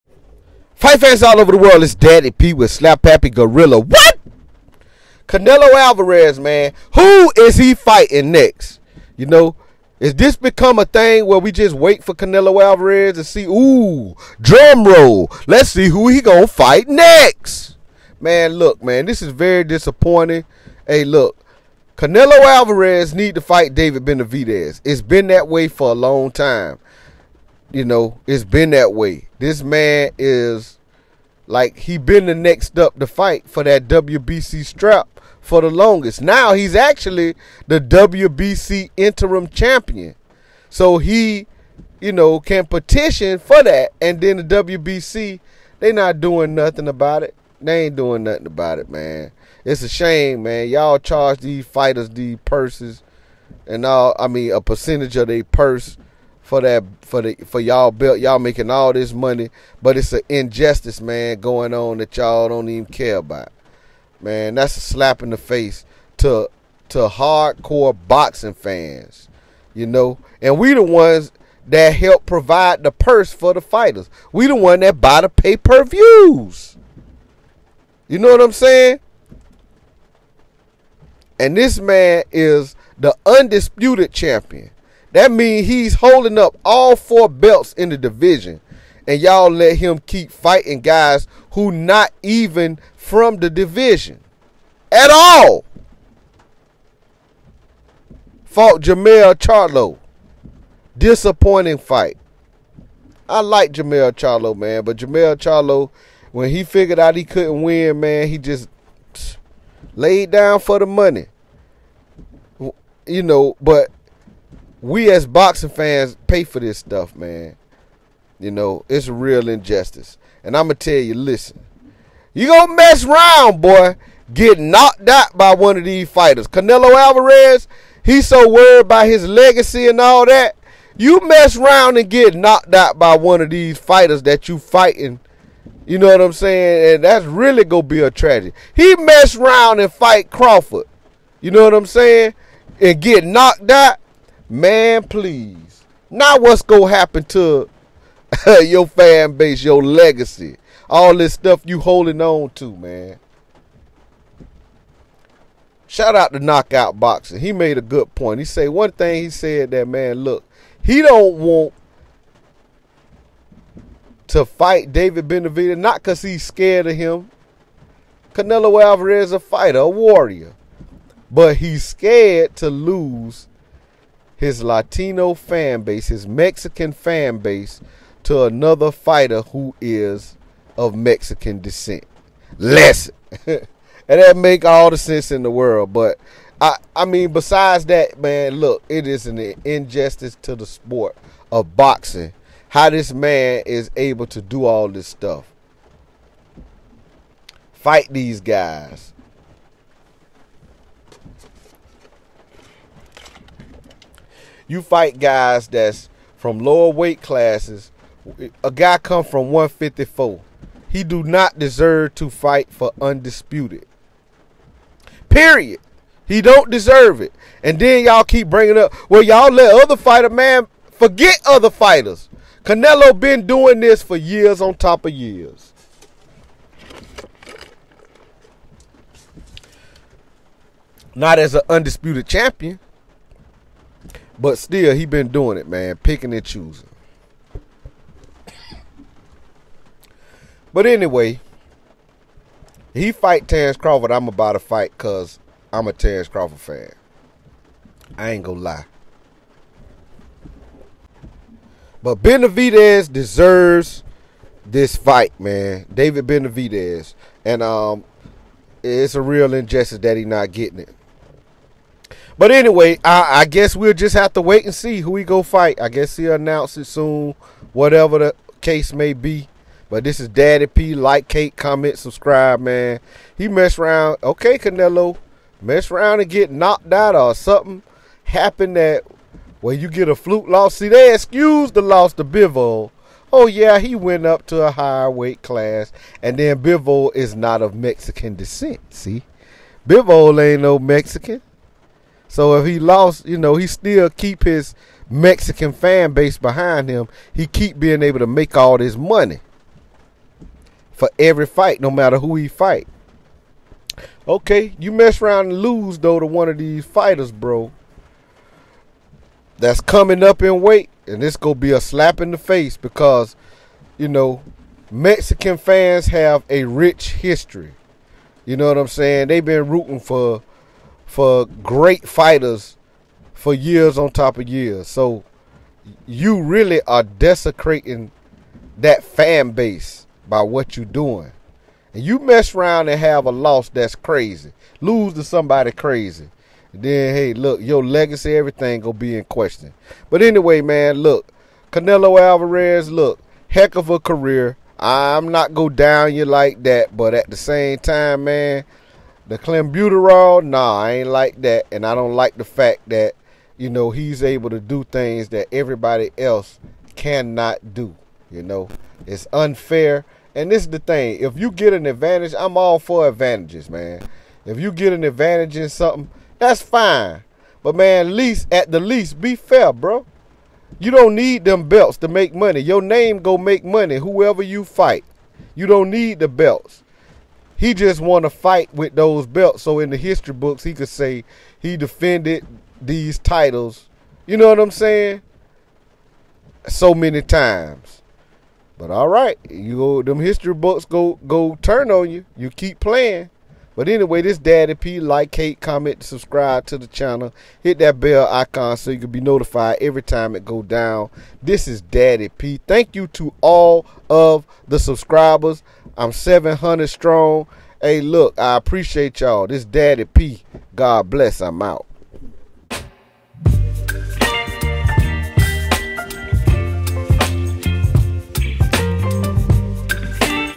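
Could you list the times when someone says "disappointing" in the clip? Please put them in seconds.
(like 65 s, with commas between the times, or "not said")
19 s, 100 s.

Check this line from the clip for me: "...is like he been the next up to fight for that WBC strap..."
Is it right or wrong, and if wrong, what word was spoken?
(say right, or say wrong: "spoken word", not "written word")
right.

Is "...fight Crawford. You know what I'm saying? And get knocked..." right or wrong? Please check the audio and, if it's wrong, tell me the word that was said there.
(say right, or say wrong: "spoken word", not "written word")
right.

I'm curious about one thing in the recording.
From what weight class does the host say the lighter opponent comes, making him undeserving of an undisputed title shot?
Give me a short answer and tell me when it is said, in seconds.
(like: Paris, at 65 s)
154, at 209 s.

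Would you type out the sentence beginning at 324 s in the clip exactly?
So you really are desecrating that fan base by what you're doing.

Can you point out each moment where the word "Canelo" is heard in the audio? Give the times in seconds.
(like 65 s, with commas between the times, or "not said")
5 s, 12 s, 21 s, 126 s, 168 s, 222 s, 274 s, 341 s.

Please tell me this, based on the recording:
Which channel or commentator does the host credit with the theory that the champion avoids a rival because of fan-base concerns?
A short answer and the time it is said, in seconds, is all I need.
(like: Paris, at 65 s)
Knockout Boxing, at 156 s.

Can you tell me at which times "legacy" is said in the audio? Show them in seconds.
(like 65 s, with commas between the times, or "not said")
129 s, 149 s, 337 s.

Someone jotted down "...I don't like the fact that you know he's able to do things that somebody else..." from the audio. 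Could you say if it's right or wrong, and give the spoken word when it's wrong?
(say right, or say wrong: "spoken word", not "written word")
wrong: "everybody", not "somebody".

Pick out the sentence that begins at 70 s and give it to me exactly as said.
And we the ones that help provide the purse for the fighters.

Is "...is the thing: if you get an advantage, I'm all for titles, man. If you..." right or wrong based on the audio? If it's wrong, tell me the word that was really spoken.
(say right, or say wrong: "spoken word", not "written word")
wrong: "advantages", not "titles".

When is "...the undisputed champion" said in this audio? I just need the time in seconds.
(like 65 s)
82 s.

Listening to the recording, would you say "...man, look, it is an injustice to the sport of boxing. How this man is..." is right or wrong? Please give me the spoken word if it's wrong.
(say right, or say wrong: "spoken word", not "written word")
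right.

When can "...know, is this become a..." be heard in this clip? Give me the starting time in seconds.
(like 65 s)
9 s.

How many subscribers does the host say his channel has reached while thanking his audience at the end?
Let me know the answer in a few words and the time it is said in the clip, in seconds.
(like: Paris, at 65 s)
700, at 406 s.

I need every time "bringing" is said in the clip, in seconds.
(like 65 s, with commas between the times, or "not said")
218 s.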